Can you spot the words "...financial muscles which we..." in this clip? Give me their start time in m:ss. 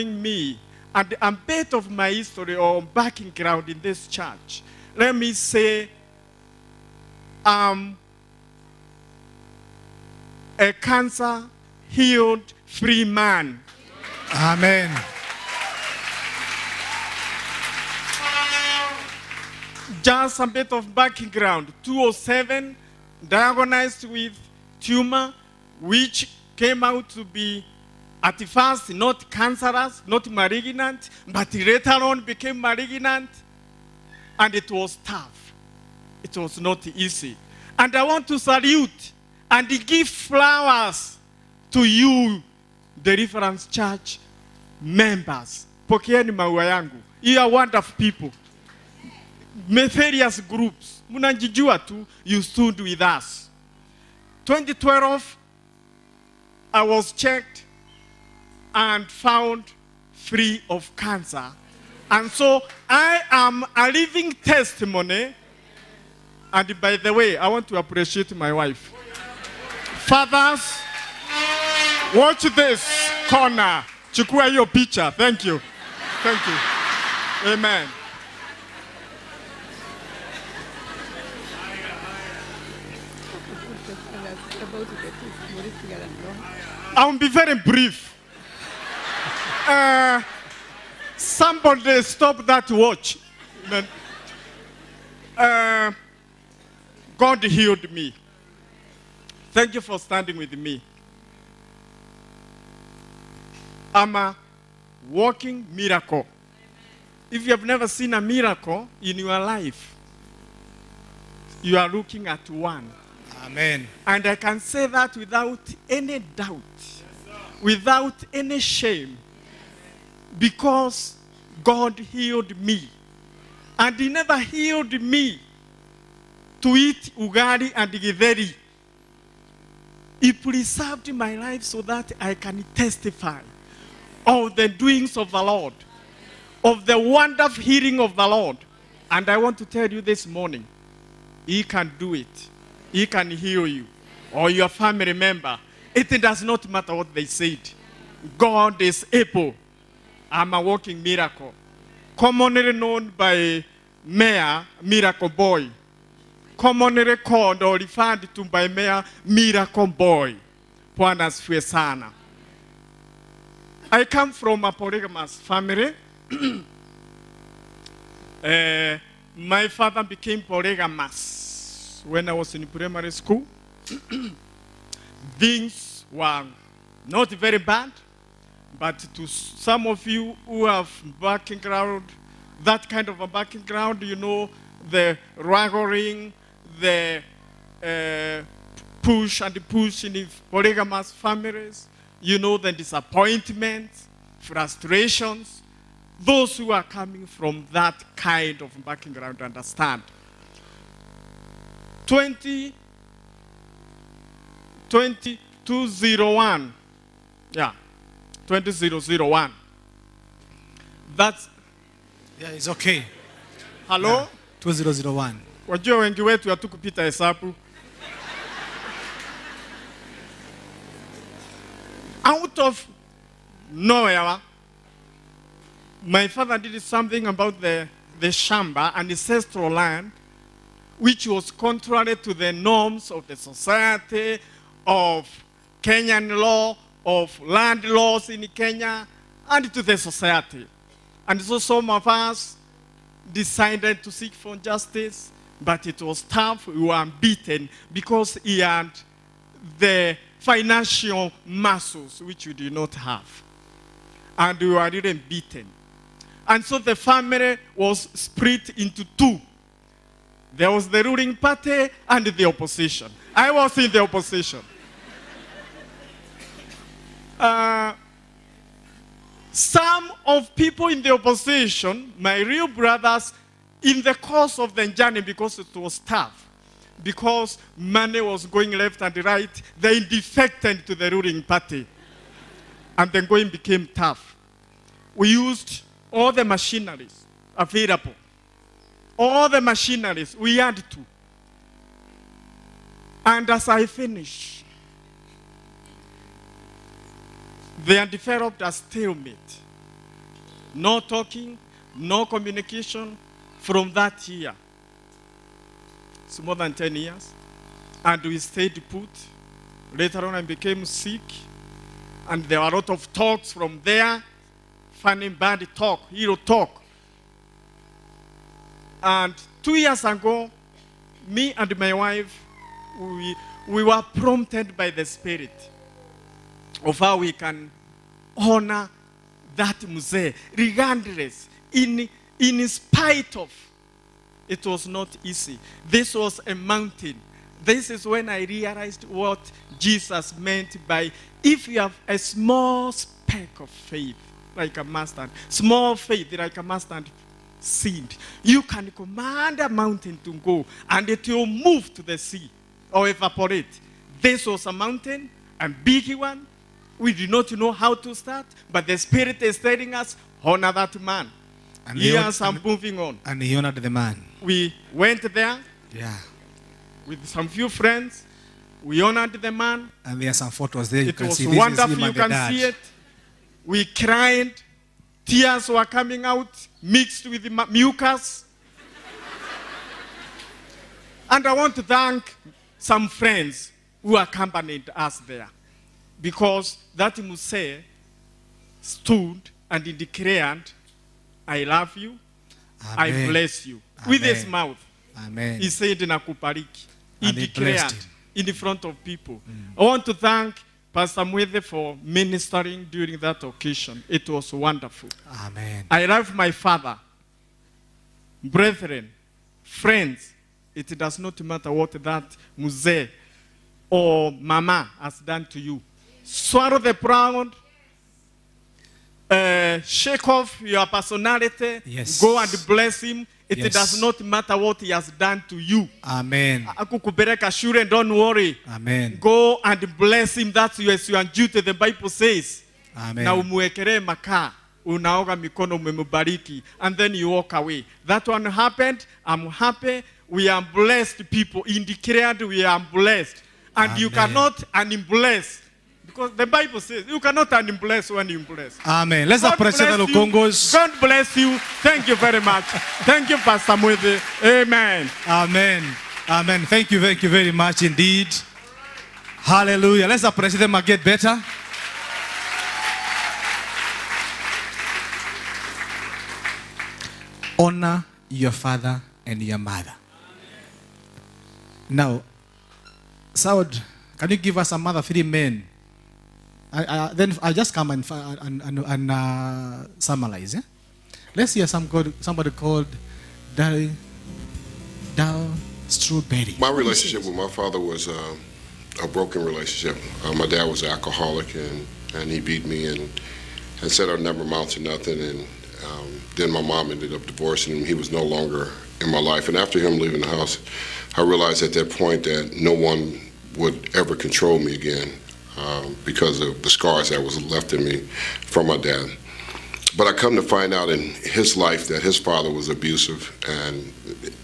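4:10.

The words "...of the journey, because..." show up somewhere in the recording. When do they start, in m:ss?
4:34.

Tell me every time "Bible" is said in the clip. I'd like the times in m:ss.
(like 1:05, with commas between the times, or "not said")
7:11, 7:26.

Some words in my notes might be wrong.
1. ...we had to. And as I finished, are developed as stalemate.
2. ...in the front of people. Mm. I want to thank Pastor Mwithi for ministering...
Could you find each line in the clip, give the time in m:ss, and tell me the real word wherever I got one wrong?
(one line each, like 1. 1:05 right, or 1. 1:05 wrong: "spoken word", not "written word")
1. 4:50 right
2. 6:38 right.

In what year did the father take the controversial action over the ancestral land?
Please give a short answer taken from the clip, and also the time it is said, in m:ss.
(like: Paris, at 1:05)
2001, at 3:34.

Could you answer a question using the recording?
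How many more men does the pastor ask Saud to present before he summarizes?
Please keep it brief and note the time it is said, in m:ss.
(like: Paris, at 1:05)
3, at 7:55.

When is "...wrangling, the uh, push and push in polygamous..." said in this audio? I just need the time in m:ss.
3:05.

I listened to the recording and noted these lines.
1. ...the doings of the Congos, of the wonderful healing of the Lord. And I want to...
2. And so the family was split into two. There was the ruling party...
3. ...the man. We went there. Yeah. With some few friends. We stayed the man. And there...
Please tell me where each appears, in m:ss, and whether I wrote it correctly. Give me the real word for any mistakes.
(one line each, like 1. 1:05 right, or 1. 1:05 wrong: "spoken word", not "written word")
1. 2:14 wrong: "Lord", not "Congos"
2. 4:16 right
3. 6:03 wrong: "honored", not "stayed".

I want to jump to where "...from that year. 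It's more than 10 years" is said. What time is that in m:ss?
5:03.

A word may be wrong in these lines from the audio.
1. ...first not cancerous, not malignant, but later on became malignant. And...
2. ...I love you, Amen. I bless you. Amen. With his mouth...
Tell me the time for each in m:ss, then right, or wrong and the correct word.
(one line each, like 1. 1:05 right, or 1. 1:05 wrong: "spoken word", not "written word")
1. 0:28 right
2. 6:31 right.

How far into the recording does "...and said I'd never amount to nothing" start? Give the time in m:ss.
8:13.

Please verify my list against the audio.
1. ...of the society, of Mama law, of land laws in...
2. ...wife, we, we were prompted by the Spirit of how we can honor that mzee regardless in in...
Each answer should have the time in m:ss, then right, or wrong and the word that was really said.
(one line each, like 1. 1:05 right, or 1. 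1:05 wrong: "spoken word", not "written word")
1. 3:53 wrong: "Kenyan", not "Mama"
2. 5:21 right.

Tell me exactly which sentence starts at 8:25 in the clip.
Um, because of the scars that was left in me from my dad.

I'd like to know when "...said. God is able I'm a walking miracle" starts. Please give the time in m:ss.
2:27.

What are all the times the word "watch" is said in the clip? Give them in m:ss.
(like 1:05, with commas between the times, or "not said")
1:12, 1:32.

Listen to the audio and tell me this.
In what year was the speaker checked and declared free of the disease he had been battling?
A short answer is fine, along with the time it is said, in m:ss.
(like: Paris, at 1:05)
2012, at 0:54.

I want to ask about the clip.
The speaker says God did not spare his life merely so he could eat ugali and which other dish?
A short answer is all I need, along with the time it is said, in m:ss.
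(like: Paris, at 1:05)
Githeri, at 2:07.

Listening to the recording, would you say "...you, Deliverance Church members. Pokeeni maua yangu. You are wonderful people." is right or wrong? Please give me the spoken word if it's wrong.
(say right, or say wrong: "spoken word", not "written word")
right.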